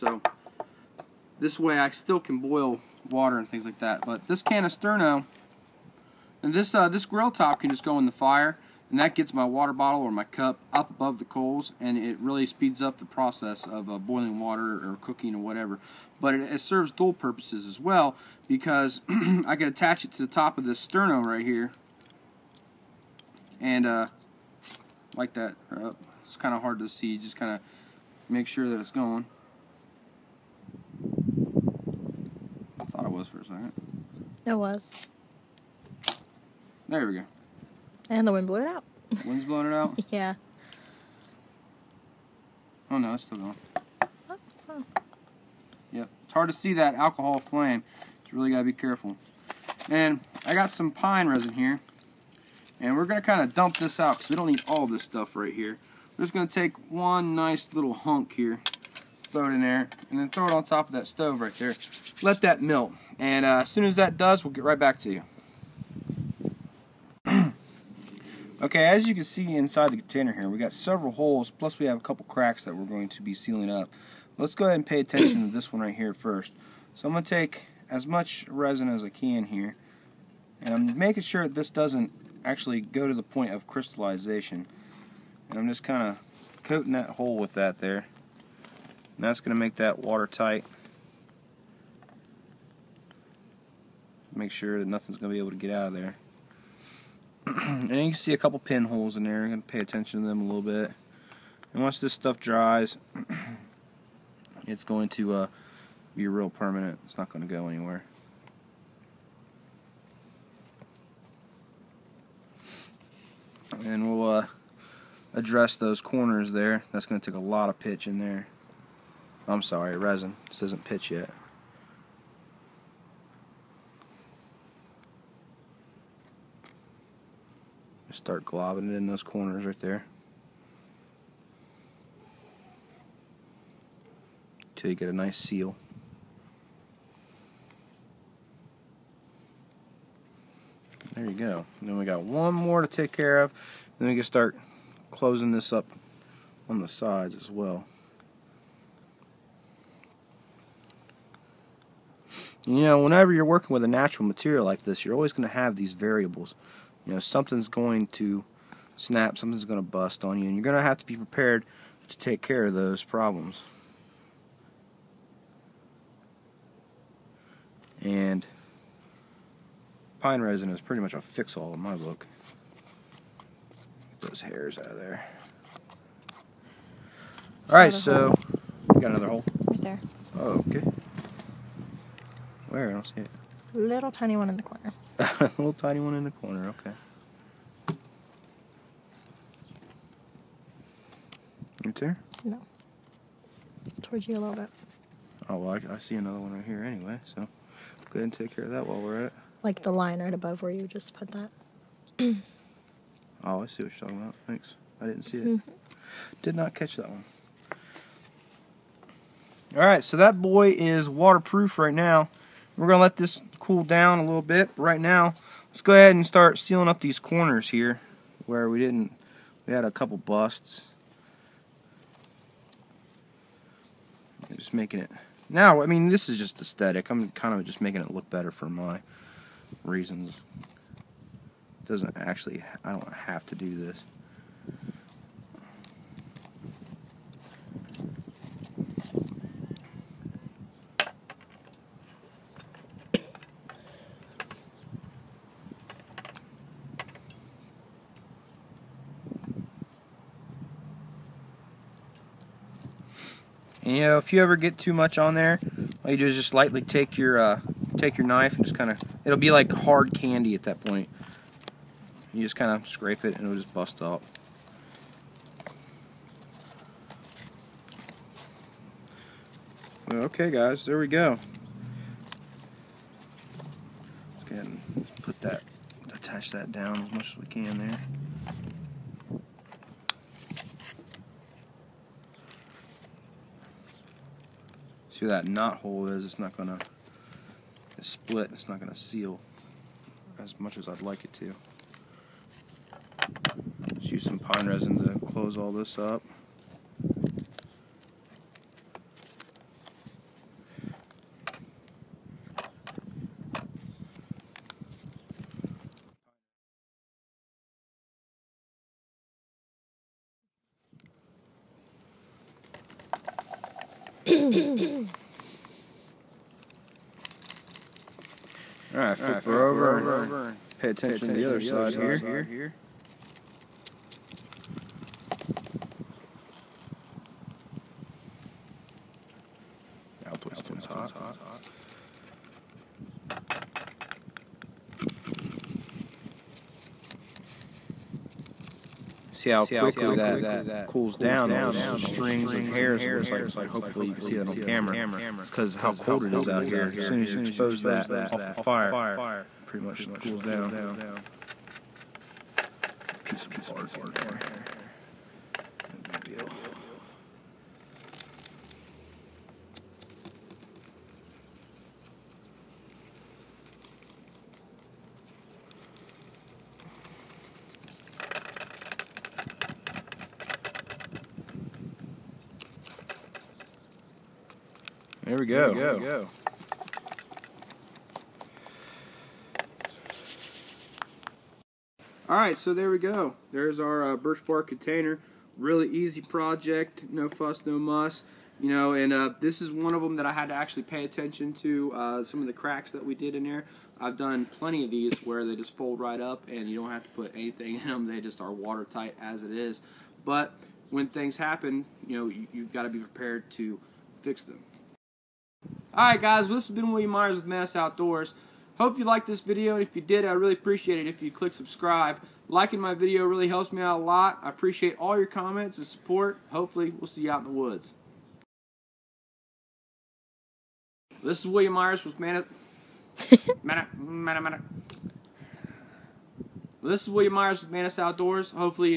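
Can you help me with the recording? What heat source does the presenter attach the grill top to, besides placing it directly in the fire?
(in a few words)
Sterno.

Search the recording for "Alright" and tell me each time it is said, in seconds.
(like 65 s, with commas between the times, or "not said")
318 s, 382 s, 405 s.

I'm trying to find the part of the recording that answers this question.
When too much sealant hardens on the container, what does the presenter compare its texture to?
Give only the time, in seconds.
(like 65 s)
259 s.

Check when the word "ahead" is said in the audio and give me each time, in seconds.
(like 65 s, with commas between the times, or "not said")
74 s, 198 s, 215 s, 274 s.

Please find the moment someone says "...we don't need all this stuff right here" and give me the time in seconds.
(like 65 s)
54 s.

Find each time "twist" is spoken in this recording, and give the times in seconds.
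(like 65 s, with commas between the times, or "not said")
330 s.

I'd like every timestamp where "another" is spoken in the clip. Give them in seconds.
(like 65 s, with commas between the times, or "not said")
179 s, 196 s.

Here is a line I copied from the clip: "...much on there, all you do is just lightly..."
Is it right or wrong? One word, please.
right.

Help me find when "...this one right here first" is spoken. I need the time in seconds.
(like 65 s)
75 s.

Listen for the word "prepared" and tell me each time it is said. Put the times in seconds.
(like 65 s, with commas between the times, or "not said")
161 s, 402 s.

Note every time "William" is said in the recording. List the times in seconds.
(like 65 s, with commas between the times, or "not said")
406 s, 421 s, 427 s.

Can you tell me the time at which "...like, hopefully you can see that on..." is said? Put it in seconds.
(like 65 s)
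343 s.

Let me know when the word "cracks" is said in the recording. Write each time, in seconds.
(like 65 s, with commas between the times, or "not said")
72 s, 392 s.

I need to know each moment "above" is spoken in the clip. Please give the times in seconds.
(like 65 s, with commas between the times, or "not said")
10 s, 200 s.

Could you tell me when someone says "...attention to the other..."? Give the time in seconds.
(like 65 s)
320 s.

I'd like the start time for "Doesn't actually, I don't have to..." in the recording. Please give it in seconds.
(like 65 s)
231 s.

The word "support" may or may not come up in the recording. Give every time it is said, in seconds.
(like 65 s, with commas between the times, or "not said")
415 s.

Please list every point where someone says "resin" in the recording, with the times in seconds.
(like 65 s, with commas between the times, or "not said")
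51 s, 78 s, 119 s, 170 s, 294 s.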